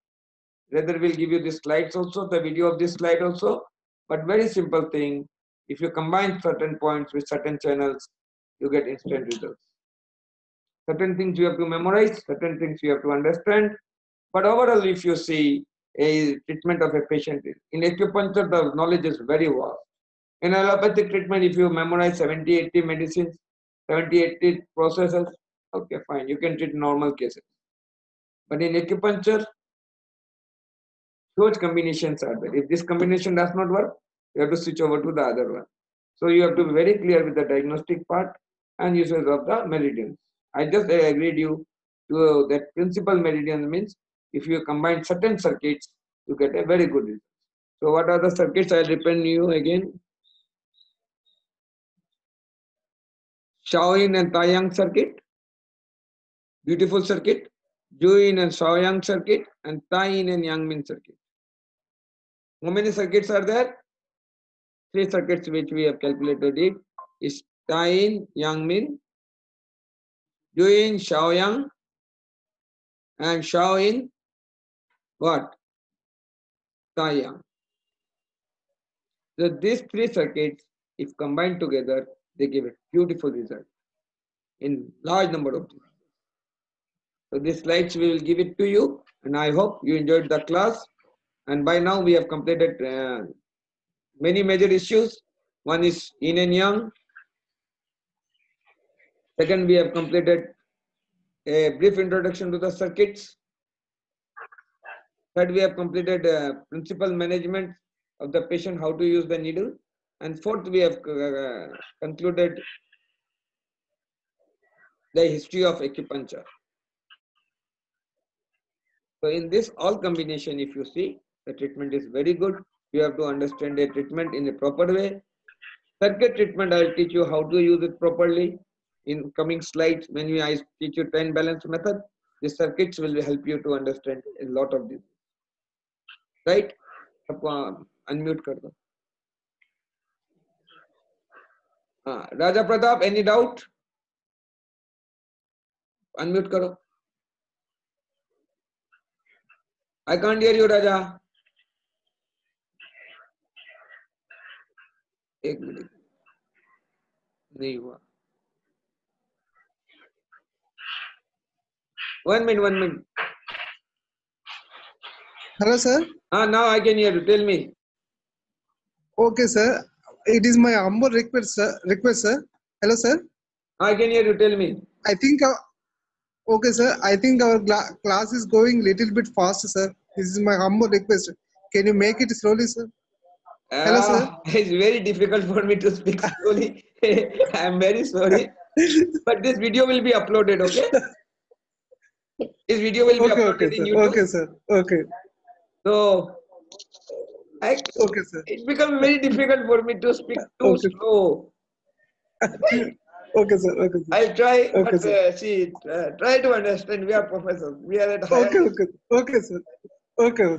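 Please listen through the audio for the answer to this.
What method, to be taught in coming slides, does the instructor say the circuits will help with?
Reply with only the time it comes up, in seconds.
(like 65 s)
131 s.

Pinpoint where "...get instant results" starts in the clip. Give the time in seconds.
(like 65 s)
8 s.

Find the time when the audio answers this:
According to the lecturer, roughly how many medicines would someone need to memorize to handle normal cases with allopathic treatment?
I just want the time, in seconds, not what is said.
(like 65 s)
22 s.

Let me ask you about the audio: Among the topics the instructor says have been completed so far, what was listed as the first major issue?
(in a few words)
yin and yang.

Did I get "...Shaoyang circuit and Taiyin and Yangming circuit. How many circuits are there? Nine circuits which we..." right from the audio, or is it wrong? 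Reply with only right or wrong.
wrong.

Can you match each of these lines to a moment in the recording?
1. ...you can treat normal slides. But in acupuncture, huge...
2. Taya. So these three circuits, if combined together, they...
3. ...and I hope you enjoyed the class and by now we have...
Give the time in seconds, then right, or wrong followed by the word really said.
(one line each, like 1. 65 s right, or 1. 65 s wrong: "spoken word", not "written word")
1. 26 s wrong: "cases", not "slides"
2. 76 s right
3. 89 s right.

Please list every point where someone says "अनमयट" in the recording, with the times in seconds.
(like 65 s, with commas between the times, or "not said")
138 s, 146 s.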